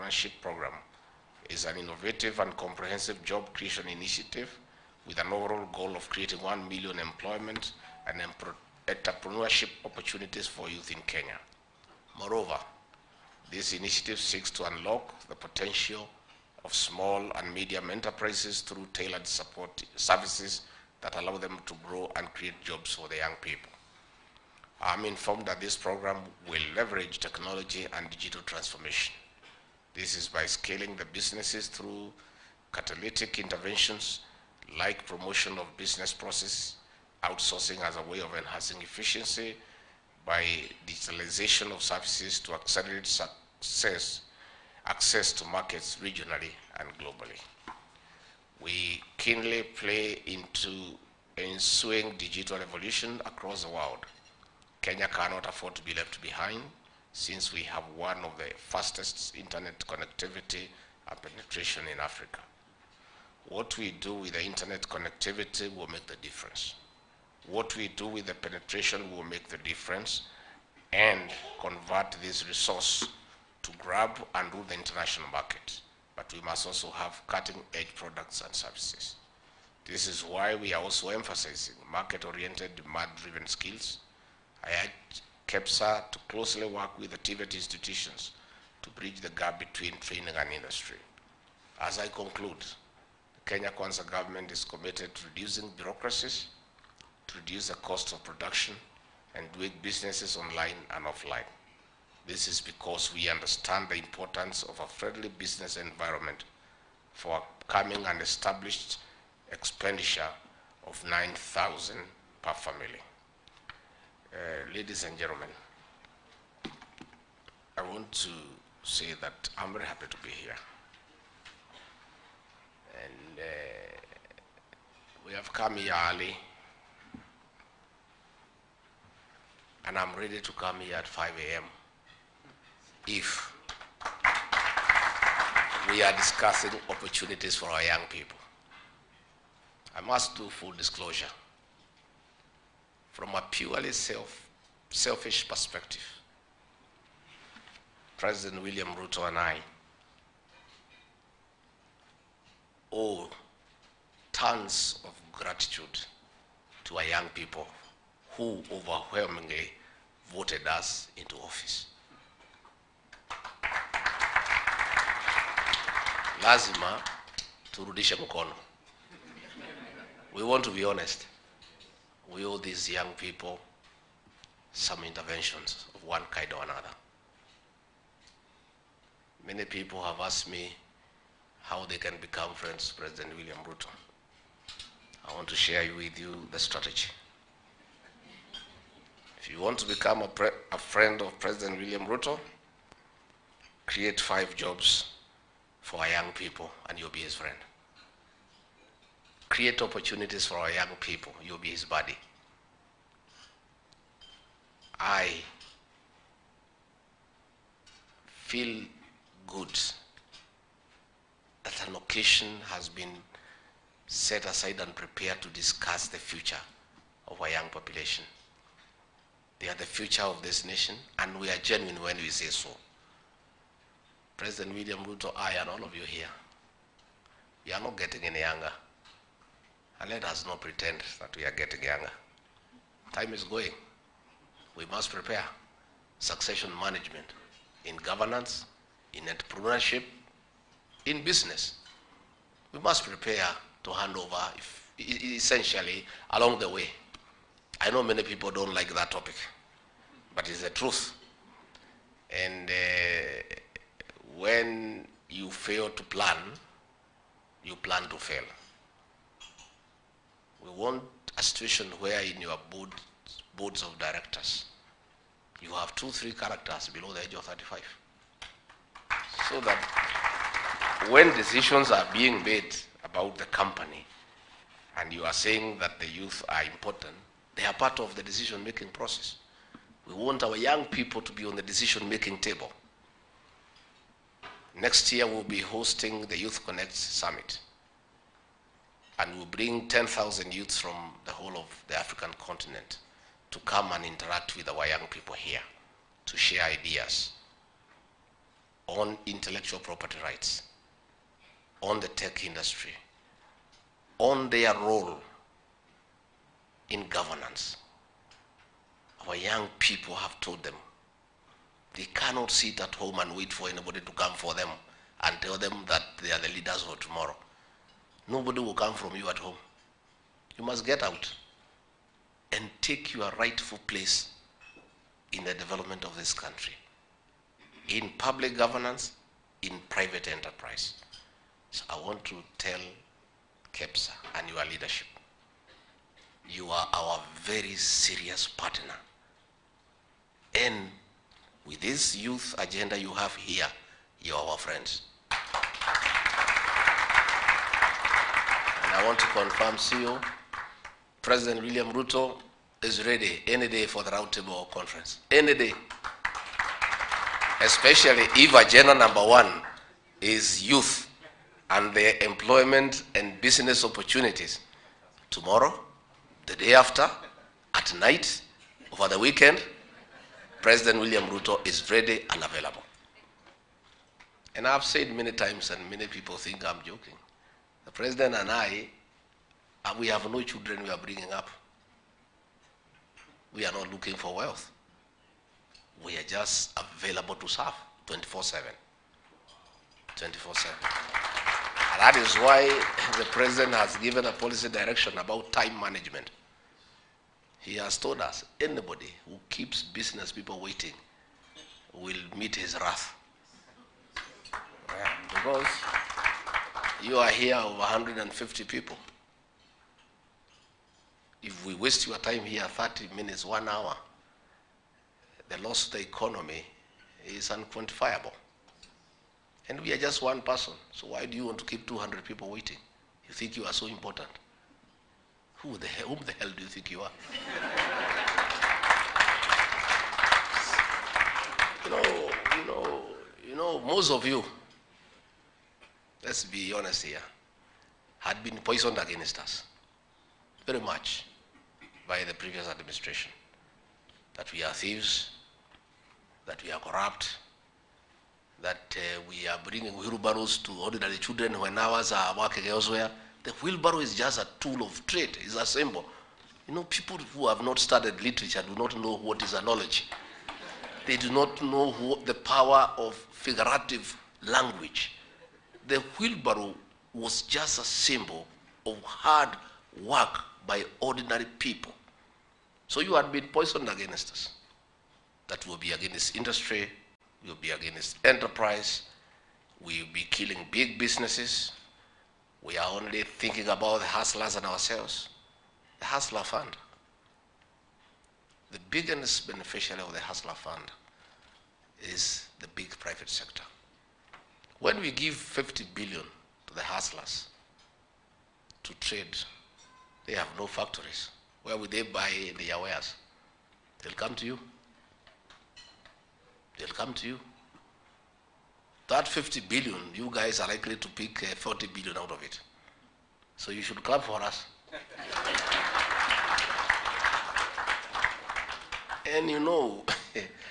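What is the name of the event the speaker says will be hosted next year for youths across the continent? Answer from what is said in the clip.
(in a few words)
Youth Connect Summit.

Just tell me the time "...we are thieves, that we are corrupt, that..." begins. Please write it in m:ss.
7:24.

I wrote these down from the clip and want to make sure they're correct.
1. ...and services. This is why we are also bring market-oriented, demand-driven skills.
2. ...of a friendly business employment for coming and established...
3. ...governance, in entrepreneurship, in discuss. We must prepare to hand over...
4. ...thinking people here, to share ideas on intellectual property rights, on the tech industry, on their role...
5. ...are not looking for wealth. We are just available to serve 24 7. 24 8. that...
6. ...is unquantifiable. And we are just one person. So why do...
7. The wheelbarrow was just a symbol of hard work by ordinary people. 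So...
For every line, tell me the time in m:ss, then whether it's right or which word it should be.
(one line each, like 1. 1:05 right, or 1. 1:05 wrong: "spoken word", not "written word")
1. 1:18 wrong: "emphasizing", not "bring"
2. 1:44 wrong: "environment", not "employment"
3. 3:57 wrong: "business", not "discuss"
4. 4:54 wrong: "young", not "thinking"
5. 6:23 wrong: "7", not "8"
6. 6:57 right
7. 7:45 right.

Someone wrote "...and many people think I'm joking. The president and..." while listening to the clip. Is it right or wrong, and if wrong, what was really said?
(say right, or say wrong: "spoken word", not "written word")
right.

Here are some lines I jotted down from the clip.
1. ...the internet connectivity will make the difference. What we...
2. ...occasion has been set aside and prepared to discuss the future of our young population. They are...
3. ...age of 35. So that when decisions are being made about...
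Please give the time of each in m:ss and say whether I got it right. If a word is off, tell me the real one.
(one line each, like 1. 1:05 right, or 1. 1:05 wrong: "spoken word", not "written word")
1. 1:04 right
2. 3:31 right
3. 4:27 right.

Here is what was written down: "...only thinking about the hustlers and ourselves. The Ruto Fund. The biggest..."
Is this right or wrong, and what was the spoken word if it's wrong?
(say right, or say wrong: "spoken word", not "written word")
wrong: "Hustler", not "Ruto".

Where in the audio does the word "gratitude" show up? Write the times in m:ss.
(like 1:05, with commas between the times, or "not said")
2:35.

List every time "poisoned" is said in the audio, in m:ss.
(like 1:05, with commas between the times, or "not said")
7:18, 7:53.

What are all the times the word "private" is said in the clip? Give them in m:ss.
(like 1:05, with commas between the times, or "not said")
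5:29, 8:12.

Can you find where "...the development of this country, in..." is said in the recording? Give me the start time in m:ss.
5:25.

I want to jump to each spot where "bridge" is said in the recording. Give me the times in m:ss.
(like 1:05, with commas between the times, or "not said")
1:28.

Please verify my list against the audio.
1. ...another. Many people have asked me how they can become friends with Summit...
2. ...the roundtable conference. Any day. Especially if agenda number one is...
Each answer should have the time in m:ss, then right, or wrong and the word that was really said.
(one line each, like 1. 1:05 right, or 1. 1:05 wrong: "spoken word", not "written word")
1. 2:56 wrong: "President", not "Summit"
2. 5:54 right.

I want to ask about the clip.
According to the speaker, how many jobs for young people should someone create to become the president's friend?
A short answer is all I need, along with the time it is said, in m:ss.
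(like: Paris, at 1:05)
5, at 3:14.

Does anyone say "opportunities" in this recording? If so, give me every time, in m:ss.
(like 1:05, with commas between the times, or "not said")
0:09, 2:16, 3:19, 6:03.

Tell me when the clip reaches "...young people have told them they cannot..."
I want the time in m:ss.
5:09.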